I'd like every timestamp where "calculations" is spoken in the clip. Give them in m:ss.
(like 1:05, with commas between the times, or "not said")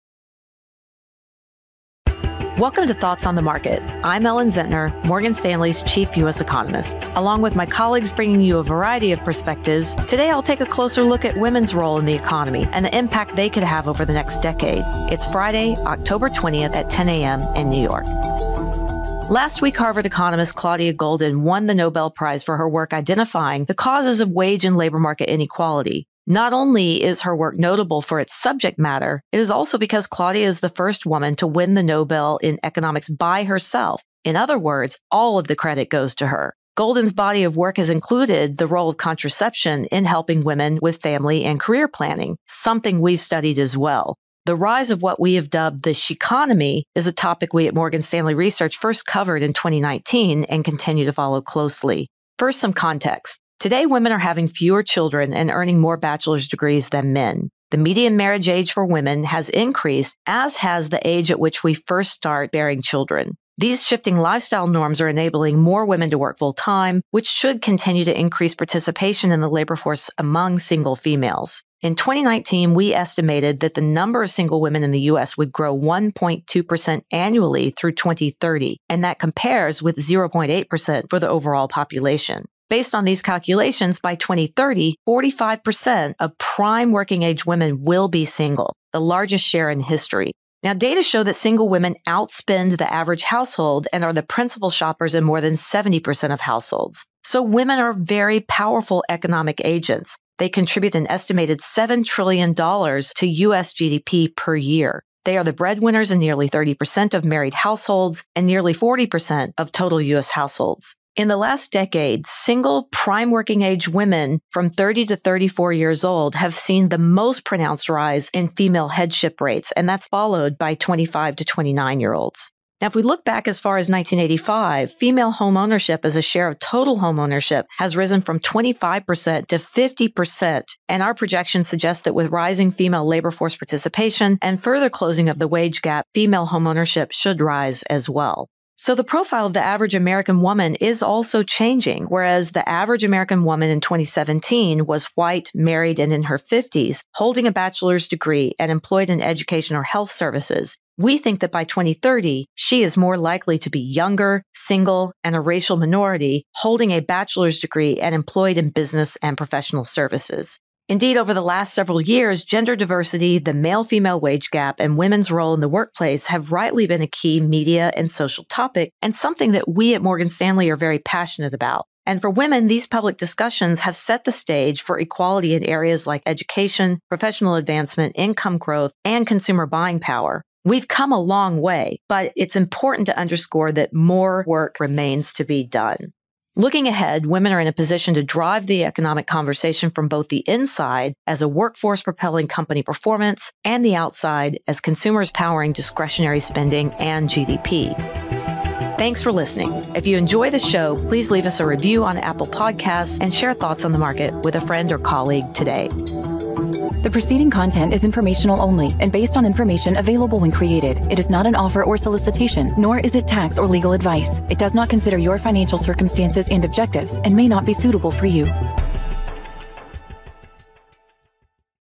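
1:23.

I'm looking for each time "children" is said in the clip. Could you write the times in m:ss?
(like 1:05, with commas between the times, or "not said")
0:54, 1:02.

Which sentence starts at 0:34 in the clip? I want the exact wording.
In other words, all of the credit goes to her.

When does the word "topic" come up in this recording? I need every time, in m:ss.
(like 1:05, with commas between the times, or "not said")
0:47, 2:48.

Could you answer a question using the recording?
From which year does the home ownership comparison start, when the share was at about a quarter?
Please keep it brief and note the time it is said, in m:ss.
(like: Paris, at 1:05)
1985, at 2:03.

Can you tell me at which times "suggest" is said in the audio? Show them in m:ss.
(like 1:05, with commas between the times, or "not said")
2:11.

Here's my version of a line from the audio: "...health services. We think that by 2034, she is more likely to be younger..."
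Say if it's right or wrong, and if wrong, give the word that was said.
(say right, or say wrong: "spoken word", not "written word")
wrong: "2030", not "2034".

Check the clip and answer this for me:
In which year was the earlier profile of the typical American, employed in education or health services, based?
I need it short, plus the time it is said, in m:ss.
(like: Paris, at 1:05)
2017, at 2:23.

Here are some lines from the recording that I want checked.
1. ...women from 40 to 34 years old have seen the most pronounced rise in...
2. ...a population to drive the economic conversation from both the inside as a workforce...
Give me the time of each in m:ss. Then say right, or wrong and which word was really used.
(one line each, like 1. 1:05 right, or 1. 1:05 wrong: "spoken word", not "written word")
1. 1:53 wrong: "30", not "40"
2. 3:07 wrong: "position", not "population".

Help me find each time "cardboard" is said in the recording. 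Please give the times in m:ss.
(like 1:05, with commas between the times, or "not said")
not said.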